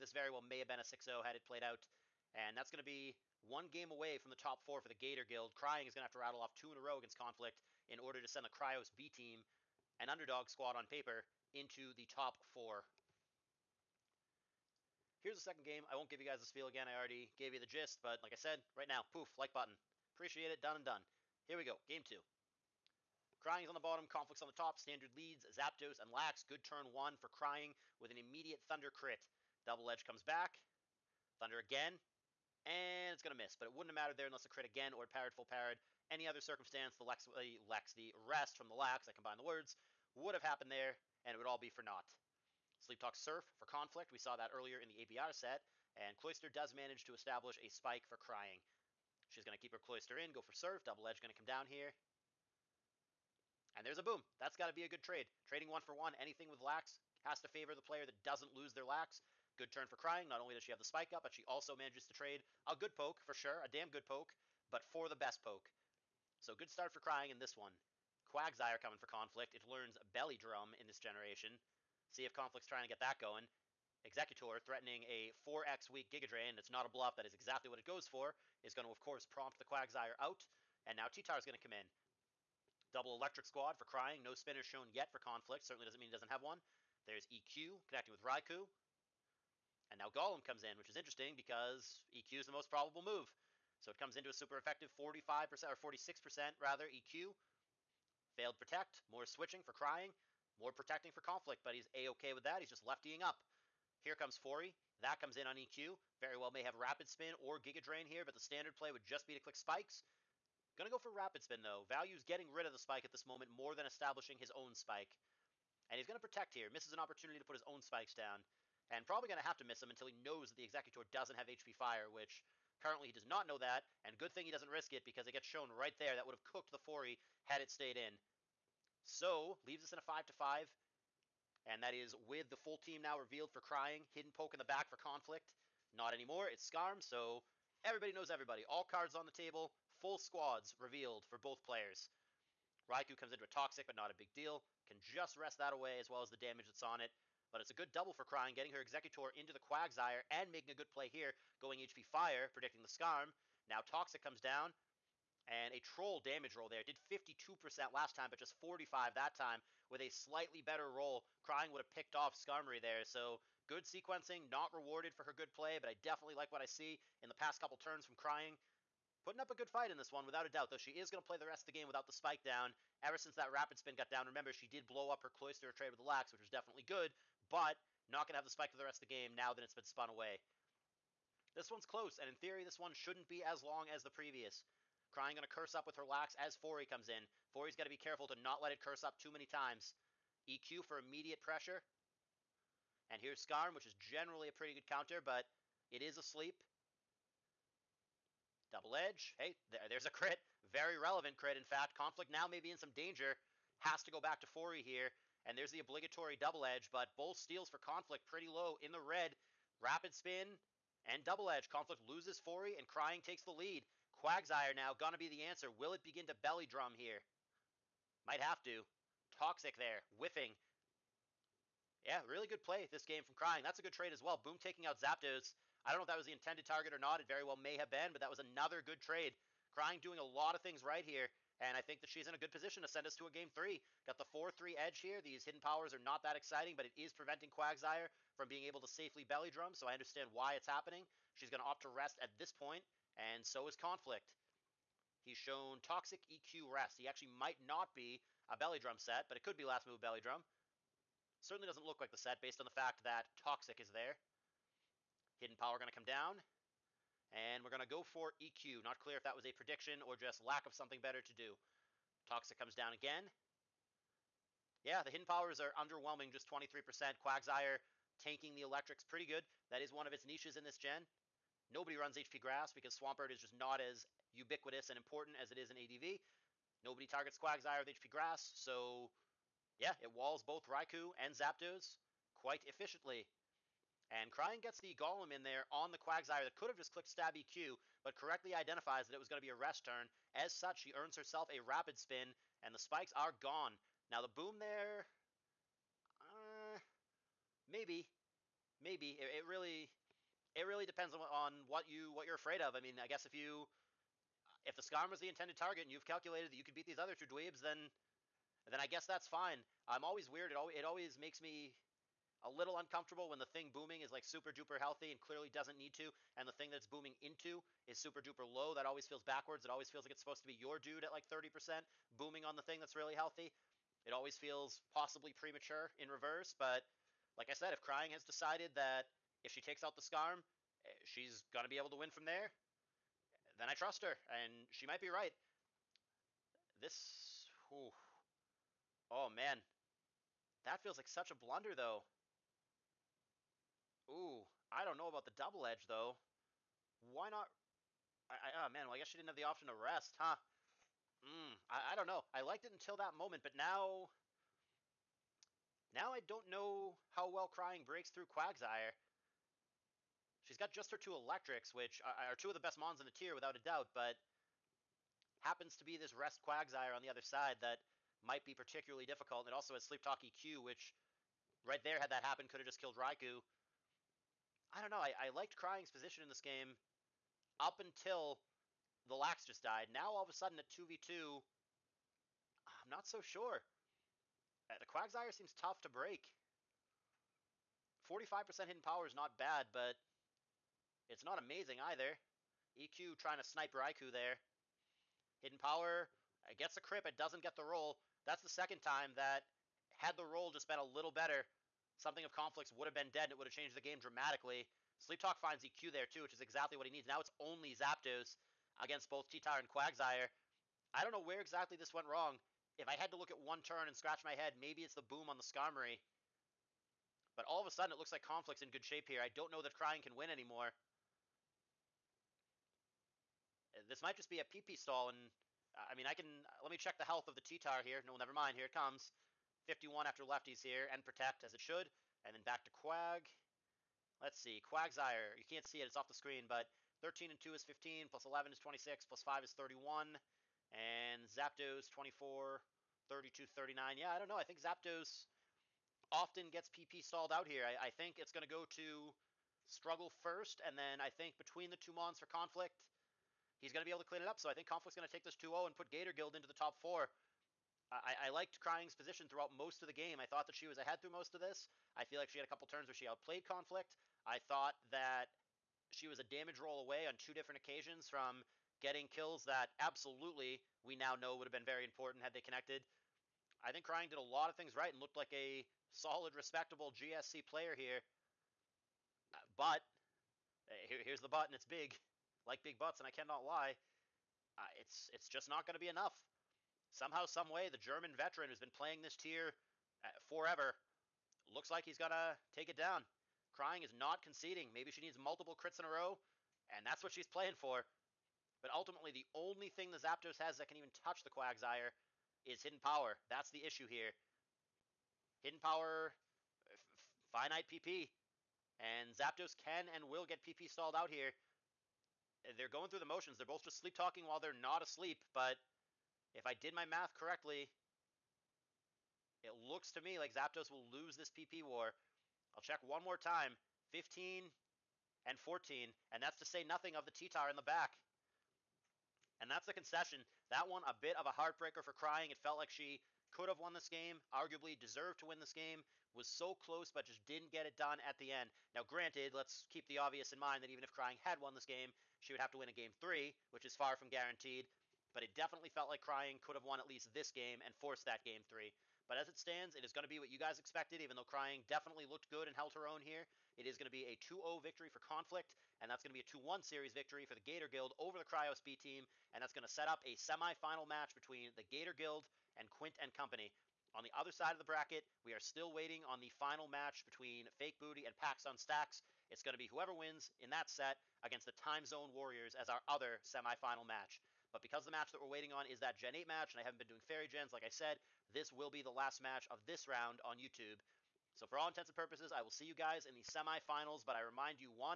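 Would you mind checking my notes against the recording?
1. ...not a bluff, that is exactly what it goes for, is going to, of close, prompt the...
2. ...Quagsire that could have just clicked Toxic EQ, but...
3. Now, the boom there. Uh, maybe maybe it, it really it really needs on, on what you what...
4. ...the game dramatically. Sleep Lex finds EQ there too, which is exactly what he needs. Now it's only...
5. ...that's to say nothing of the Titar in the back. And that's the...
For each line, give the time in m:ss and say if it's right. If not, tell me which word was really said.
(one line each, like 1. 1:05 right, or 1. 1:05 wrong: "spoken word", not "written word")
1. 1:16 wrong: "course", not "close"
2. 4:45 wrong: "Stab", not "Toxic"
3. 4:54 wrong: "depends", not "needs"
4. 6:43 wrong: "Talk", not "Lex"
5. 8:46 right.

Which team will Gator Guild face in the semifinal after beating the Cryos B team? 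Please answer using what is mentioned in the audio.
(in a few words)
Quint and Company.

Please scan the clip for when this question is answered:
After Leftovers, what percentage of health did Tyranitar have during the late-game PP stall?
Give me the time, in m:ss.
7:09.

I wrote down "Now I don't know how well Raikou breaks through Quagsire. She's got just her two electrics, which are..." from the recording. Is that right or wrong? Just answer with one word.
wrong.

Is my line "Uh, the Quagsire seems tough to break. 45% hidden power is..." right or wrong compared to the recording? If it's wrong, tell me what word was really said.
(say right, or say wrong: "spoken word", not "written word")
right.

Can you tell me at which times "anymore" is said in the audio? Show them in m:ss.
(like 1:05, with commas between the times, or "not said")
2:16, 7:00.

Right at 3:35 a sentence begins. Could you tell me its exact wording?
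Will it begin to belly drum here?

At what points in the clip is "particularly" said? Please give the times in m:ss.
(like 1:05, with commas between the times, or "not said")
6:08.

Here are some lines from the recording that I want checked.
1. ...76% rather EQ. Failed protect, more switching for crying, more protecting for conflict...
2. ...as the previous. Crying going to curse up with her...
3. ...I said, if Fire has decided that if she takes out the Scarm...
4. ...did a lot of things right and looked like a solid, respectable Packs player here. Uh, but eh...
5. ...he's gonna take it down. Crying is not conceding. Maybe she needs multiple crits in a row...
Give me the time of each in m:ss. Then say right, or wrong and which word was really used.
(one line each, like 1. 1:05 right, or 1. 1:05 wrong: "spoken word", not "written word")
1. 1:35 wrong: "46", not "76"
2. 3:03 right
3. 5:27 wrong: "Crying", not "Fire"
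4. 7:54 wrong: "GSC", not "Packs"
5. 8:11 right.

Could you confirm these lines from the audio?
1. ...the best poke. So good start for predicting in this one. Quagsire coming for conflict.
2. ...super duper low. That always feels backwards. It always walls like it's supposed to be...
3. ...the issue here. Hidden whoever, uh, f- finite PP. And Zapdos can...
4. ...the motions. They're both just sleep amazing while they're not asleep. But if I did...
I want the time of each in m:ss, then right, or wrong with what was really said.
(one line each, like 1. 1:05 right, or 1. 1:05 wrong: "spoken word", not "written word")
1. 1:05 wrong: "crying", not "predicting"
2. 5:17 wrong: "feels", not "walls"
3. 8:23 wrong: "power", not "whoever"
4. 8:32 wrong: "talking", not "amazing".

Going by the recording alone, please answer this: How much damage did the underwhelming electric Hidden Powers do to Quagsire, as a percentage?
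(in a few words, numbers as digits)
23%.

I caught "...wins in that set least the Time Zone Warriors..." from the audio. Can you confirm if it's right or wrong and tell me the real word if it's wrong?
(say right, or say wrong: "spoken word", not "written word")
wrong: "against", not "least".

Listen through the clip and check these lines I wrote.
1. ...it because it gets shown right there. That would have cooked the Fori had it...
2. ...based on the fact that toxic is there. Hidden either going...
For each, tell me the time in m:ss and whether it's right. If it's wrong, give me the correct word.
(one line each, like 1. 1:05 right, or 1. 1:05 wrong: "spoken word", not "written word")
1. 2:04 right
2. 4:12 wrong: "power", not "either".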